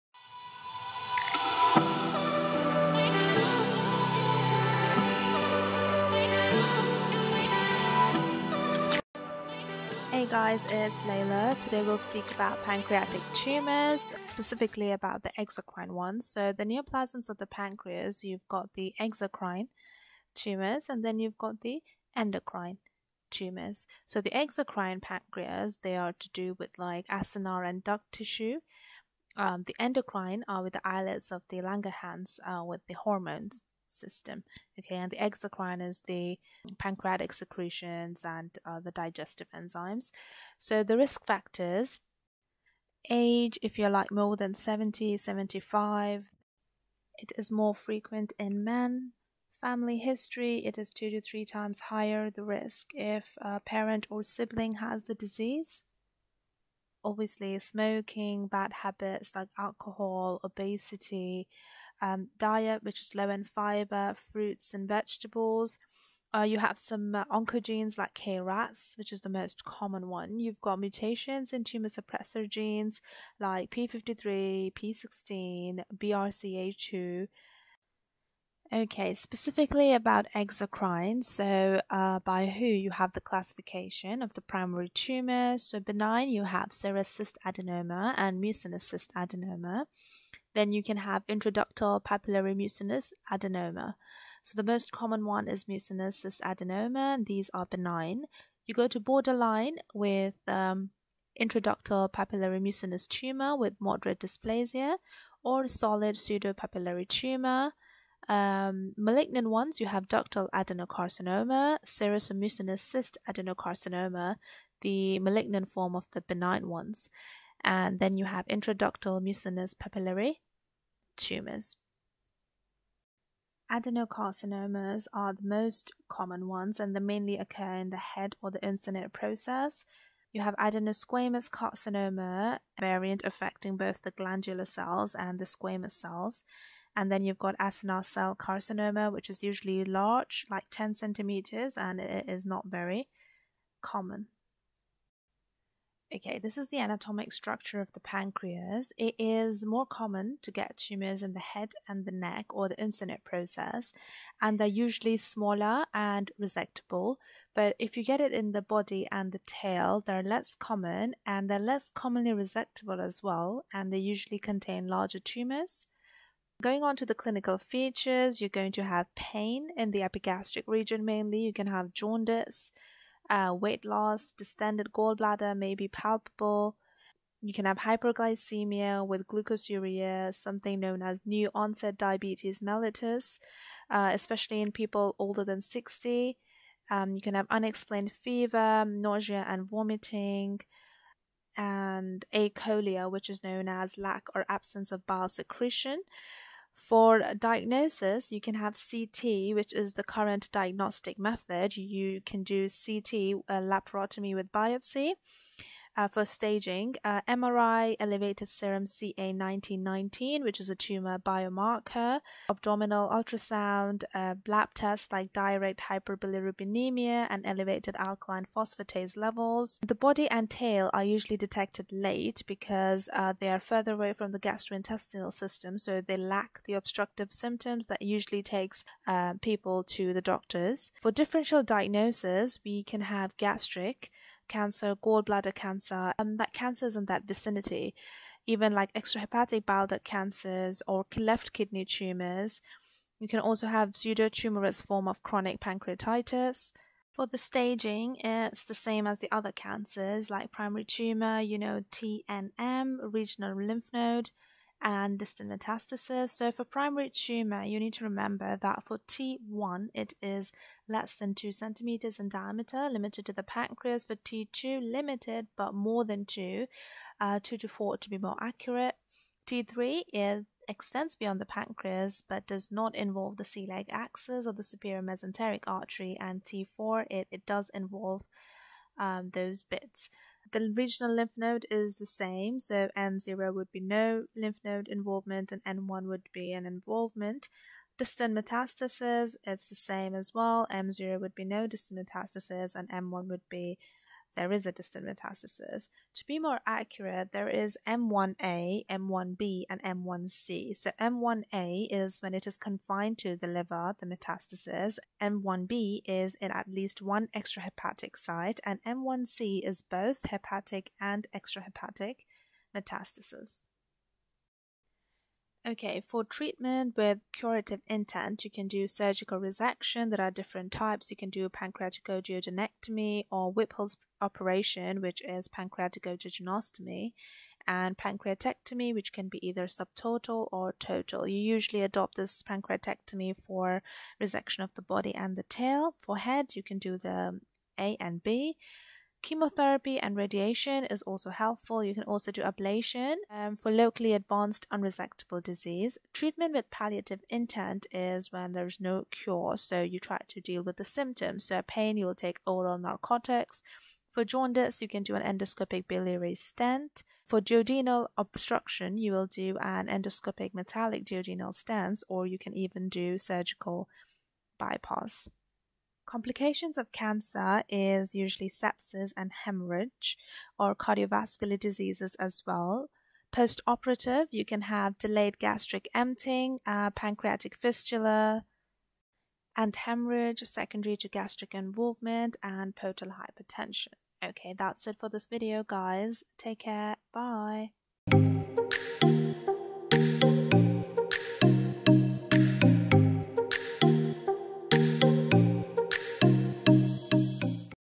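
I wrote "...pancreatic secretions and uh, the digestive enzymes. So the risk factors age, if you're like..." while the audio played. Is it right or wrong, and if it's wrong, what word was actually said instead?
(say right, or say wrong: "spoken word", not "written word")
right.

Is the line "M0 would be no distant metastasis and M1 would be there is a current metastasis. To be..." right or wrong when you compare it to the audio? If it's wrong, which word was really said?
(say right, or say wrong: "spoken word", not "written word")
wrong: "distant", not "current".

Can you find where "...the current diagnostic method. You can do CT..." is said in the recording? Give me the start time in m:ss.
3:19.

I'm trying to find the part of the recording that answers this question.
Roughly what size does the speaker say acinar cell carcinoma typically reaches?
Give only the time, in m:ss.
2:20.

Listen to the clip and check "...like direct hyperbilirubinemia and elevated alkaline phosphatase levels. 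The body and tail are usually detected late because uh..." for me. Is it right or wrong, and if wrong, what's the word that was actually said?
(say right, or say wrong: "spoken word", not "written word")
right.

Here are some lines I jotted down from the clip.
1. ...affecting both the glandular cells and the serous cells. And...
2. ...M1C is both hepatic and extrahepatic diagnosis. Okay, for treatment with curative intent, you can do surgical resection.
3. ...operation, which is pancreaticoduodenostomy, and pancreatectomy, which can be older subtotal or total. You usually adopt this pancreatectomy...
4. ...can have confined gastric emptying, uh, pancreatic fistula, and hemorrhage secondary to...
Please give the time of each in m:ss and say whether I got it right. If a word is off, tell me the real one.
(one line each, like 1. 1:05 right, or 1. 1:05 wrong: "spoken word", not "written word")
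1. 2:13 wrong: "squamous", not "serous"
2. 5:08 wrong: "metastasis", not "diagnosis"
3. 5:24 wrong: "either", not "older"
4. 6:14 wrong: "delayed", not "confined".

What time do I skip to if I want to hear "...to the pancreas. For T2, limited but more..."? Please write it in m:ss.
4:23.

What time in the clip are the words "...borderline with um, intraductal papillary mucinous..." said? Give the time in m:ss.
1:38.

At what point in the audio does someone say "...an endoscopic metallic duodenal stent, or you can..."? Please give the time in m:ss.
5:59.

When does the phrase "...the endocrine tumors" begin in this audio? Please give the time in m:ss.
0:21.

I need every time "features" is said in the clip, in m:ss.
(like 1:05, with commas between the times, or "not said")
2:47.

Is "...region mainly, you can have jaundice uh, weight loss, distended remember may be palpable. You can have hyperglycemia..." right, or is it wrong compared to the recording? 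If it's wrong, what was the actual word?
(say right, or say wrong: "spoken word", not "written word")
wrong: "gallbladder", not "remember".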